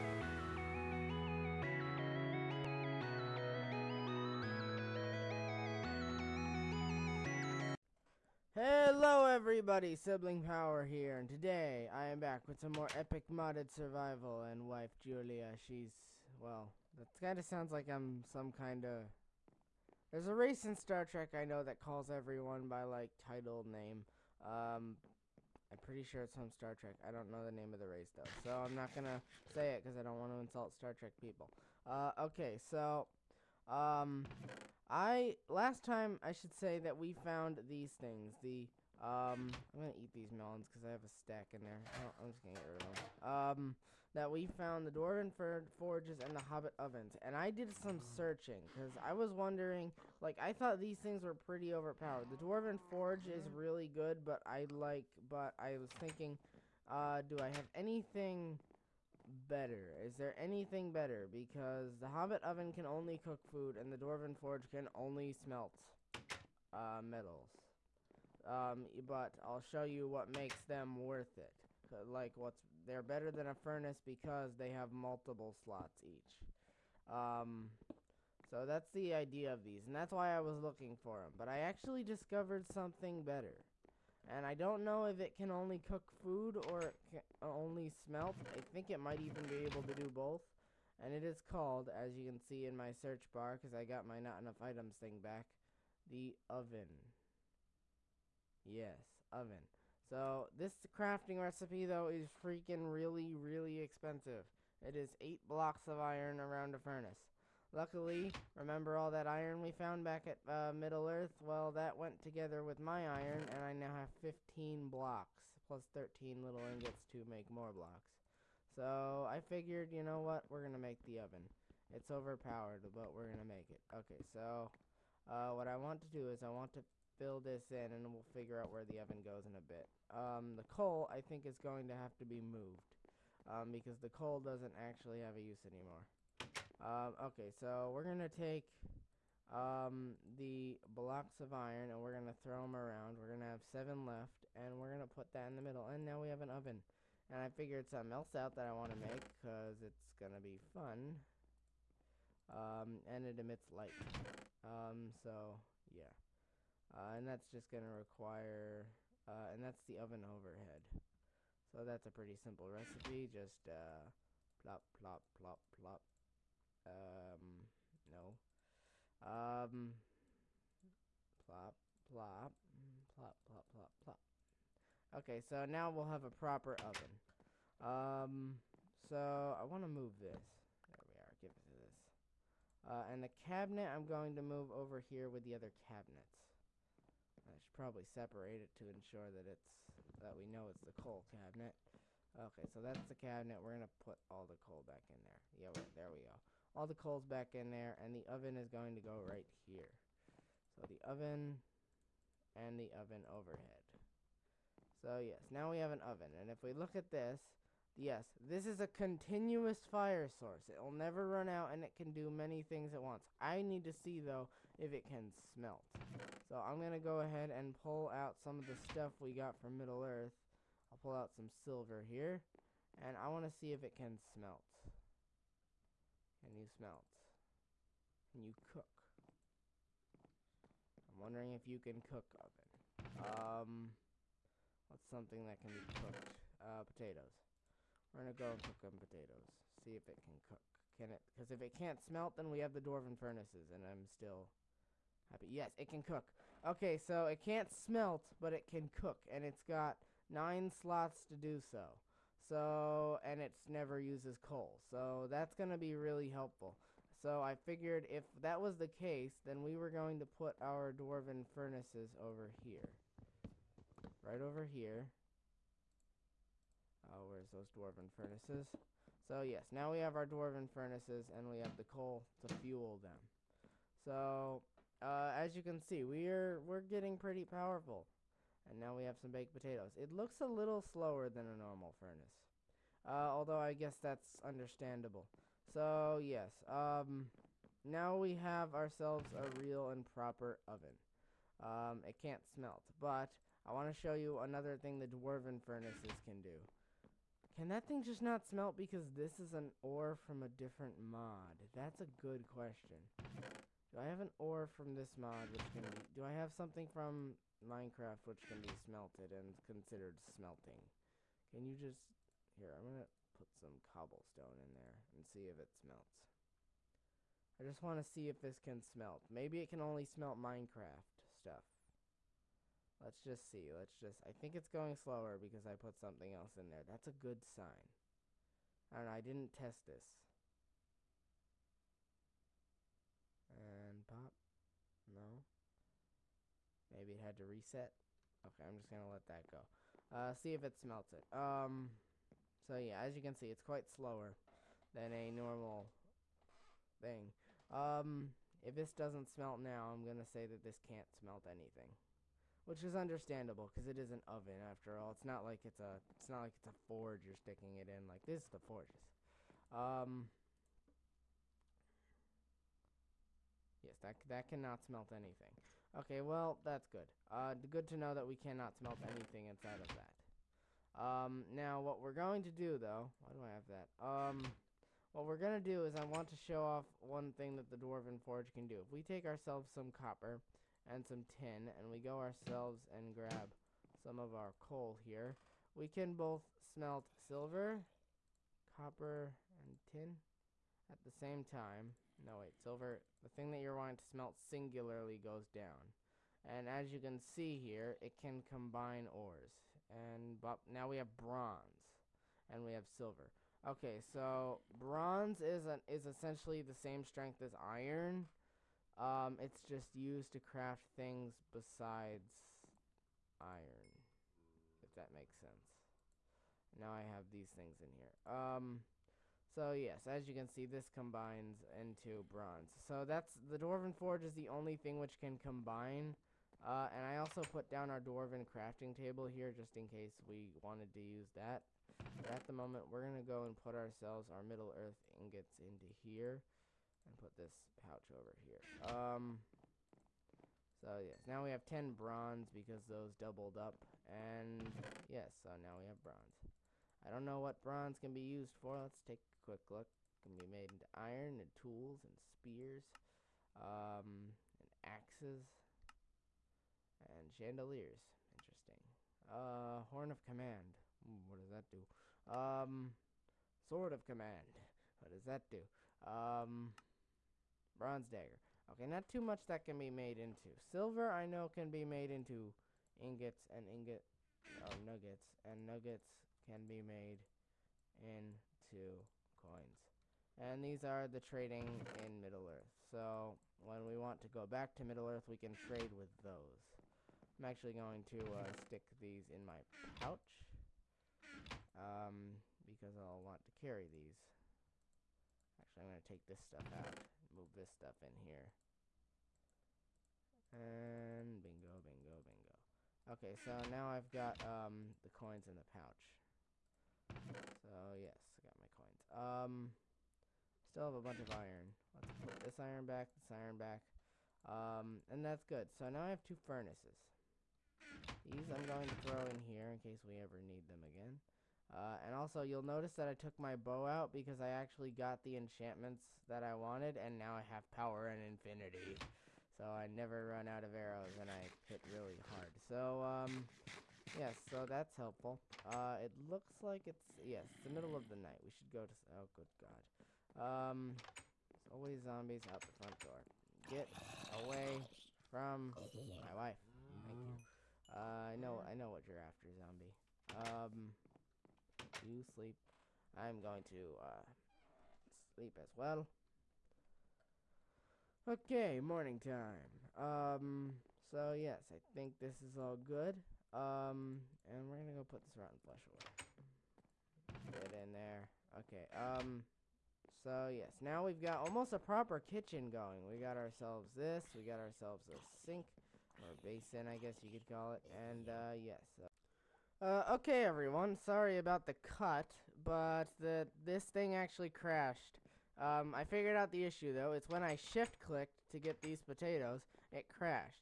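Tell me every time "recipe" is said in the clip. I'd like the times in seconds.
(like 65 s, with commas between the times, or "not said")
101 s, 162 s.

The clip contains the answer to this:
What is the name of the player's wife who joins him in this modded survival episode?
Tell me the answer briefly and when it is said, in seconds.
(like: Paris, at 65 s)
Julia, at 14 s.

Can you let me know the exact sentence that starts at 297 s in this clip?
Can that thing just not smelt because this is an ore from a different mod?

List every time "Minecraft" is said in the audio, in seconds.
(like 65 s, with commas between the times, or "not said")
307 s, 320 s.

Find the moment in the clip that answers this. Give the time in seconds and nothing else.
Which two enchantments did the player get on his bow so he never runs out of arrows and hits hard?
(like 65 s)
527 s.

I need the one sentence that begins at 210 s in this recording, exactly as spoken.
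It'll never run out and it can do many things at once.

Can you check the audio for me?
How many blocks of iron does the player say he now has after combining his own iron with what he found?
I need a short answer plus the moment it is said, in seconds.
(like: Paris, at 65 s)
15, at 114 s.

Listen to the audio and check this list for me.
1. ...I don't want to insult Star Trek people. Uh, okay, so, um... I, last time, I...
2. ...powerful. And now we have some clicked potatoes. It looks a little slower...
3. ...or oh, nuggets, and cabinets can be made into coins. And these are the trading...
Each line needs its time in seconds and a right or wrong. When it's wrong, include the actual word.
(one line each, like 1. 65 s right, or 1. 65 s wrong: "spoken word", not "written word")
1. 29 s right
2. 277 s wrong: "baked", not "clicked"
3. 474 s wrong: "nuggets", not "cabinets".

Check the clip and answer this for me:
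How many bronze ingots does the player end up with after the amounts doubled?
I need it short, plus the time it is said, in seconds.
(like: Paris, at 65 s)
10, at 441 s.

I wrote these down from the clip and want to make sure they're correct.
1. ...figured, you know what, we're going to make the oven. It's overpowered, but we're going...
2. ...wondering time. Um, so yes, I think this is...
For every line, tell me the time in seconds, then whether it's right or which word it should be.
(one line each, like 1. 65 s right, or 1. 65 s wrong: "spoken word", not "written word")
1. 119 s right
2. 558 s wrong: "morning", not "wondering".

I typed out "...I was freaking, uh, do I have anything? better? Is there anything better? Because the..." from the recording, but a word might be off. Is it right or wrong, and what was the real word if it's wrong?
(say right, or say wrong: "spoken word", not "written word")
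wrong: "thinking", not "freaking".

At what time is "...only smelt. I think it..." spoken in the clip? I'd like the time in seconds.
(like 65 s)
87 s.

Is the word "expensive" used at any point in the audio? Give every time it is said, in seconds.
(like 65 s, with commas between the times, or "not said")
103 s.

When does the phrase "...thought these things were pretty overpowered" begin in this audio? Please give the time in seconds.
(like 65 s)
50 s.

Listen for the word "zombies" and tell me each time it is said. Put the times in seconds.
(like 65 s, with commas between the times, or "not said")
542 s, 549 s.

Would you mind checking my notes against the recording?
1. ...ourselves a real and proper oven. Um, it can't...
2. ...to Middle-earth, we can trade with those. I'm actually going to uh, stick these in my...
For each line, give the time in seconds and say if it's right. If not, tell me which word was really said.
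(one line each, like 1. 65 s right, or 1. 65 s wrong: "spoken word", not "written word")
1. 288 s right
2. 484 s right.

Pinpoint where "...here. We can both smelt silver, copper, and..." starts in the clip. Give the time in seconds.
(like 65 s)
384 s.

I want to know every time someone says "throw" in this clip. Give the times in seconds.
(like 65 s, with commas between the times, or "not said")
142 s, 518 s.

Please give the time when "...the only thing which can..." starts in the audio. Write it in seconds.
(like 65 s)
424 s.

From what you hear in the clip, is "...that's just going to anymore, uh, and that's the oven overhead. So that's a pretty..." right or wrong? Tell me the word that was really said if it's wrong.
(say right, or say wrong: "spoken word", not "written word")
wrong: "require", not "anymore".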